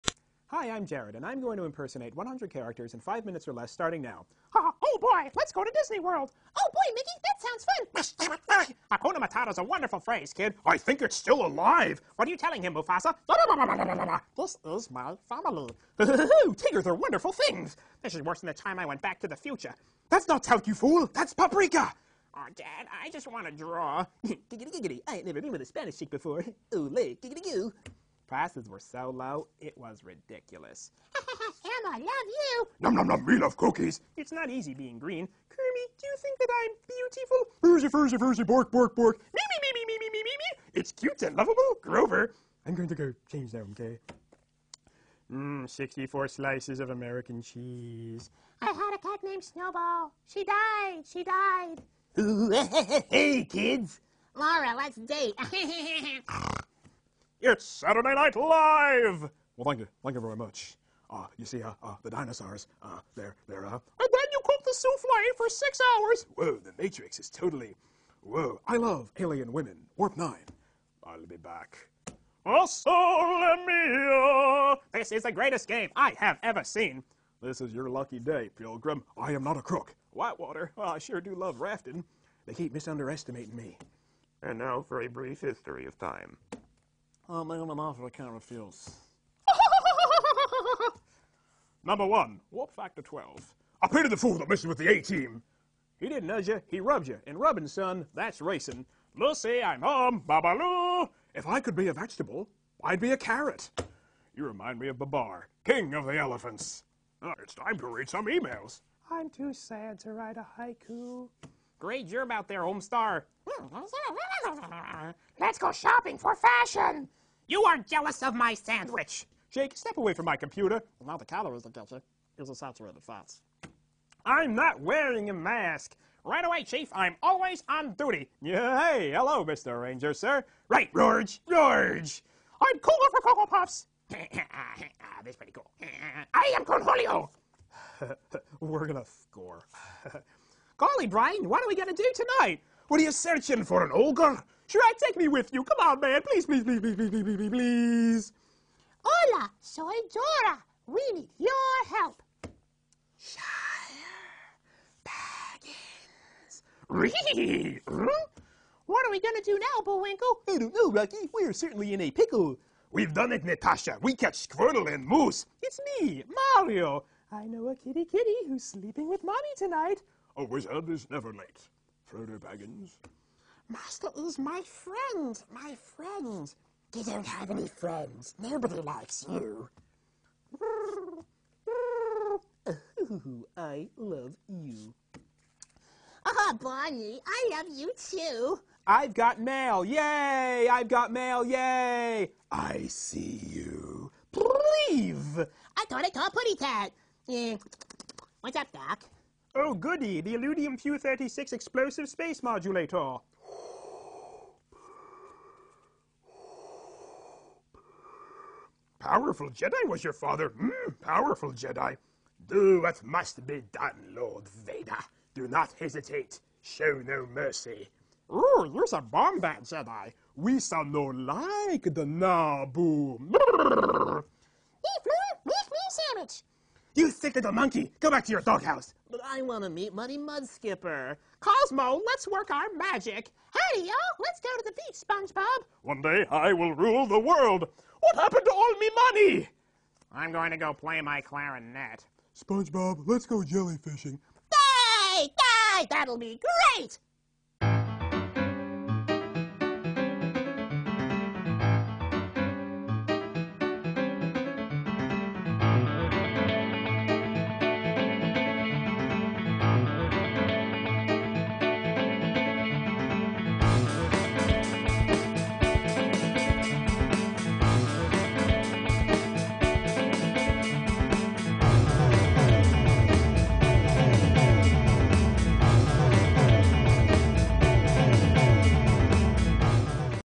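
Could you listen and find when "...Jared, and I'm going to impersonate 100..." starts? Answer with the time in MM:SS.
00:00.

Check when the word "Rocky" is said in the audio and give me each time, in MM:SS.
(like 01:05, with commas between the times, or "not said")
02:40.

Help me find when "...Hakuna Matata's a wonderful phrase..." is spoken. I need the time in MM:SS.
00:08.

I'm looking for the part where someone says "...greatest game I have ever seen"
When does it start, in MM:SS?
01:15.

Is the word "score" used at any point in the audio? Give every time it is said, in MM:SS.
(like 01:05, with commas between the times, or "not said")
02:19.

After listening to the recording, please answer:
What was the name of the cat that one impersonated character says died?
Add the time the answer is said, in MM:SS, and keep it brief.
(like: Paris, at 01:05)
Snowball, at 00:49.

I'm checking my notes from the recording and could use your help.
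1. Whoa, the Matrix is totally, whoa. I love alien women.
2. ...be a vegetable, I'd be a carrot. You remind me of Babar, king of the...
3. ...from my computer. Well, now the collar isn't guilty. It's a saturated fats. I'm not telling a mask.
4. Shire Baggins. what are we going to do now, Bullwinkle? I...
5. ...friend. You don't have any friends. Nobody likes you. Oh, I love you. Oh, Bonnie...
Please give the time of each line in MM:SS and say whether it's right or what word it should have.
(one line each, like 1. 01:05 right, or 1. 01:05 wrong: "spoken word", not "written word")
1. 01:06 right
2. 01:41 right
3. 02:00 wrong: "wearing", not "telling"
4. 02:33 right
5. 02:55 right.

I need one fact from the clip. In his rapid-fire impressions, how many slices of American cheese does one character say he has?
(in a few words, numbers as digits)
64.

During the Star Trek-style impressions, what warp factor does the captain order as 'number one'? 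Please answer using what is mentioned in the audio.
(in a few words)
12.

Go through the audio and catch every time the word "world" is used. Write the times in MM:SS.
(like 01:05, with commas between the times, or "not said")
00:06, 03:57.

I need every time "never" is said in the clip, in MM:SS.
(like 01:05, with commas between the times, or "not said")
00:25, 02:51.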